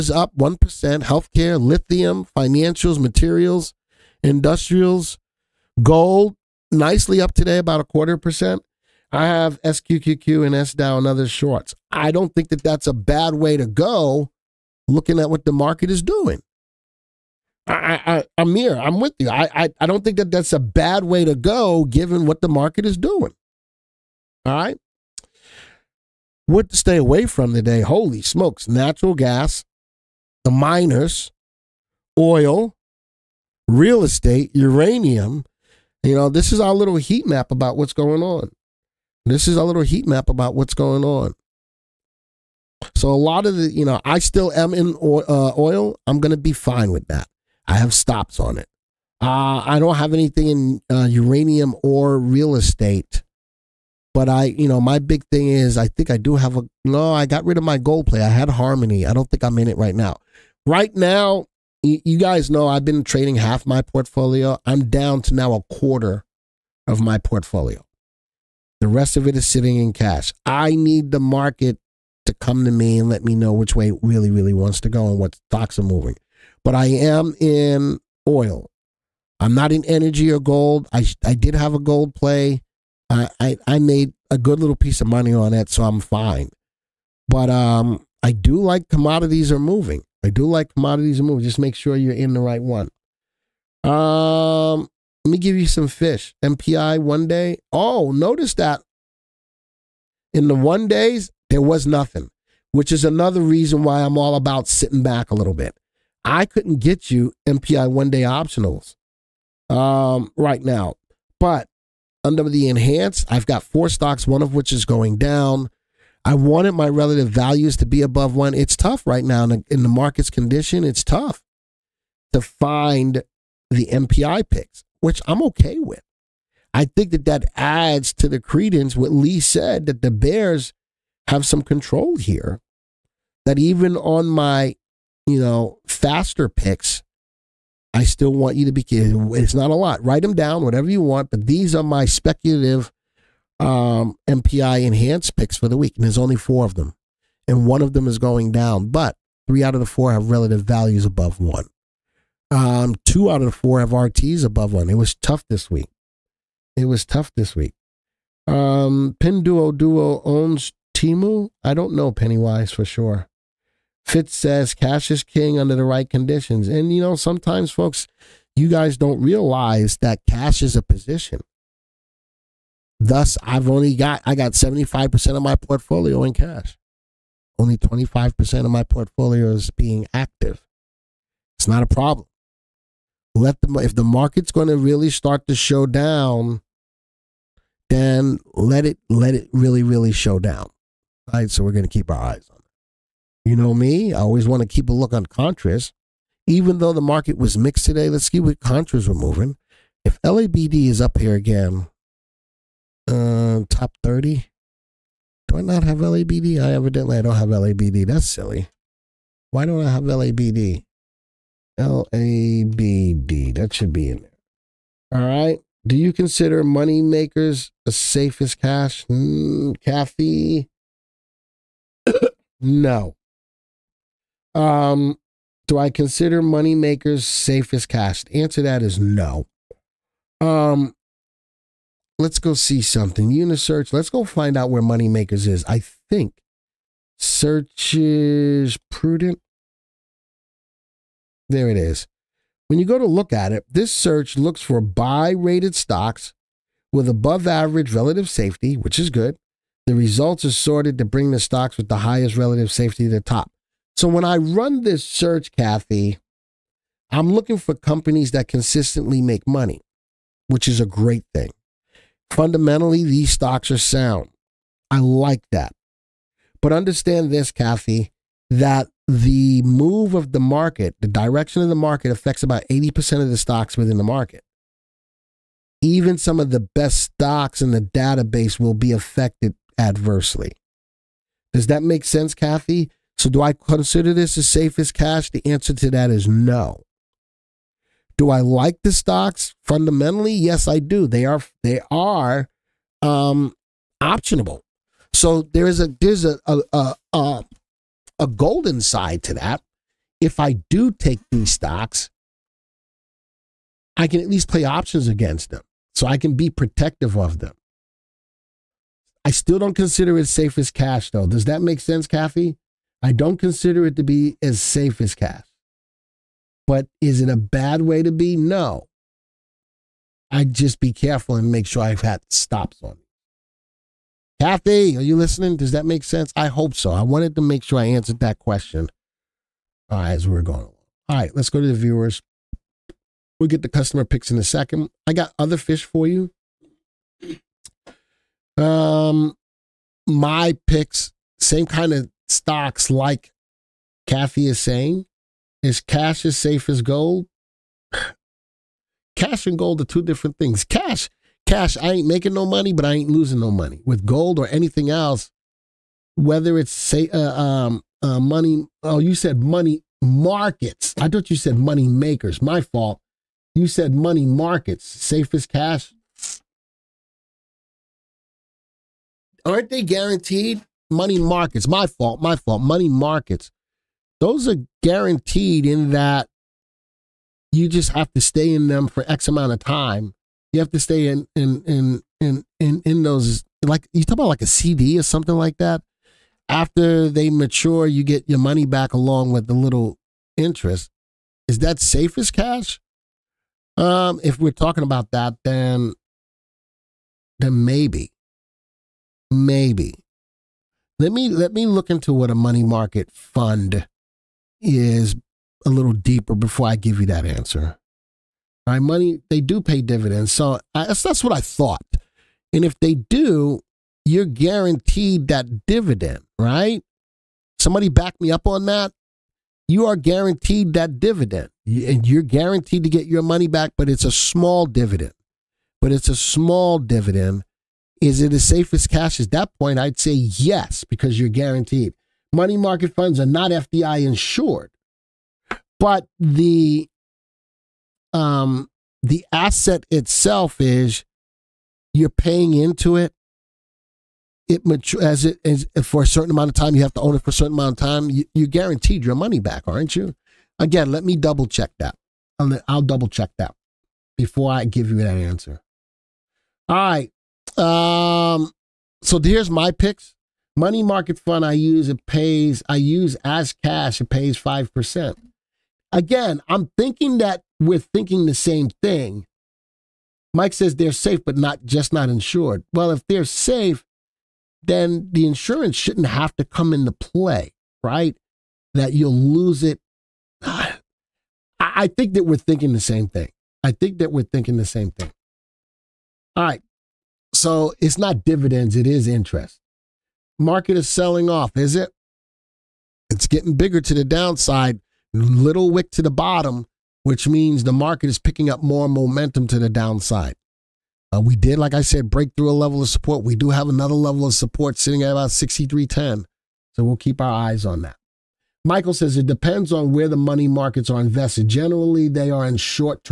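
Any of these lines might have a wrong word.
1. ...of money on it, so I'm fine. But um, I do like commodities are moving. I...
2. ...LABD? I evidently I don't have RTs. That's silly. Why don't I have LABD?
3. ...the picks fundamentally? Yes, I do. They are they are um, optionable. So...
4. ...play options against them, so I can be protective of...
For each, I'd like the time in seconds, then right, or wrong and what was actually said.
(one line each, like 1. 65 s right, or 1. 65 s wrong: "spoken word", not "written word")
1. 85 s right
2. 205 s wrong: "LABD", not "RTs"
3. 288 s wrong: "stocks", not "picks"
4. 304 s right.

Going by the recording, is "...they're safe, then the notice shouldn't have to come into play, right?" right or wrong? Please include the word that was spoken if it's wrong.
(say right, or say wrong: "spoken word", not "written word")
wrong: "insurance", not "notice".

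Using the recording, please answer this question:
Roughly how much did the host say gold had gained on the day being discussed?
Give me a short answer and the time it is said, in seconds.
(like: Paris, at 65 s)
a quarter percent, at 7 s.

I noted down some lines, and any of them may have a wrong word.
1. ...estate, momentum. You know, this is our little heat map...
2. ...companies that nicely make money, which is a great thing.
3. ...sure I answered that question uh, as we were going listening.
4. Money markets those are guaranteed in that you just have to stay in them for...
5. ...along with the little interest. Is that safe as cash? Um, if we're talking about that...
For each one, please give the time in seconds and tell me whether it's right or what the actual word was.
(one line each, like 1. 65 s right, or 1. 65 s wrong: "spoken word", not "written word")
1. 34 s wrong: "uranium", not "momentum"
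2. 257 s wrong: "consistently", not "nicely"
3. 327 s wrong: "along", not "listening"
4. 372 s right
5. 388 s right.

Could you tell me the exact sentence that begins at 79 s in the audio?
I'm not in energy or gold.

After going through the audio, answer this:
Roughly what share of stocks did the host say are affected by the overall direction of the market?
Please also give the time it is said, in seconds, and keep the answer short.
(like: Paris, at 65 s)
80%, at 272 s.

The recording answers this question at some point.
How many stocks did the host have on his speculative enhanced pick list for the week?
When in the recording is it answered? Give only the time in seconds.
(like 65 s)
113 s.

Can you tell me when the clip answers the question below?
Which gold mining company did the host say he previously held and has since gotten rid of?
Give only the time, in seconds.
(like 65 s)
58 s.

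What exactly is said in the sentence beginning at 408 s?
All right, money, they do pay dividends.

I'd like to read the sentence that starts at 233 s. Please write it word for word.
Unisearch, let's go find out where Moneymakers is.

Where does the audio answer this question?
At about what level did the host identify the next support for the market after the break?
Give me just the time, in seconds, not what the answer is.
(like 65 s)
505 s.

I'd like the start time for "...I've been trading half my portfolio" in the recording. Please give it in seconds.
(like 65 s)
62 s.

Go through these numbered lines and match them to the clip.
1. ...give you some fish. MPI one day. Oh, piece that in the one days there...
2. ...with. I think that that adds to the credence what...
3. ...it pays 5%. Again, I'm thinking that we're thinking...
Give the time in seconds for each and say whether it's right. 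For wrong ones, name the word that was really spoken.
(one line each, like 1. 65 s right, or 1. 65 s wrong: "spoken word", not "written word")
1. 95 s wrong: "notice", not "piece"
2. 125 s right
3. 464 s right.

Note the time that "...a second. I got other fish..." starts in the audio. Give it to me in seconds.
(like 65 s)
334 s.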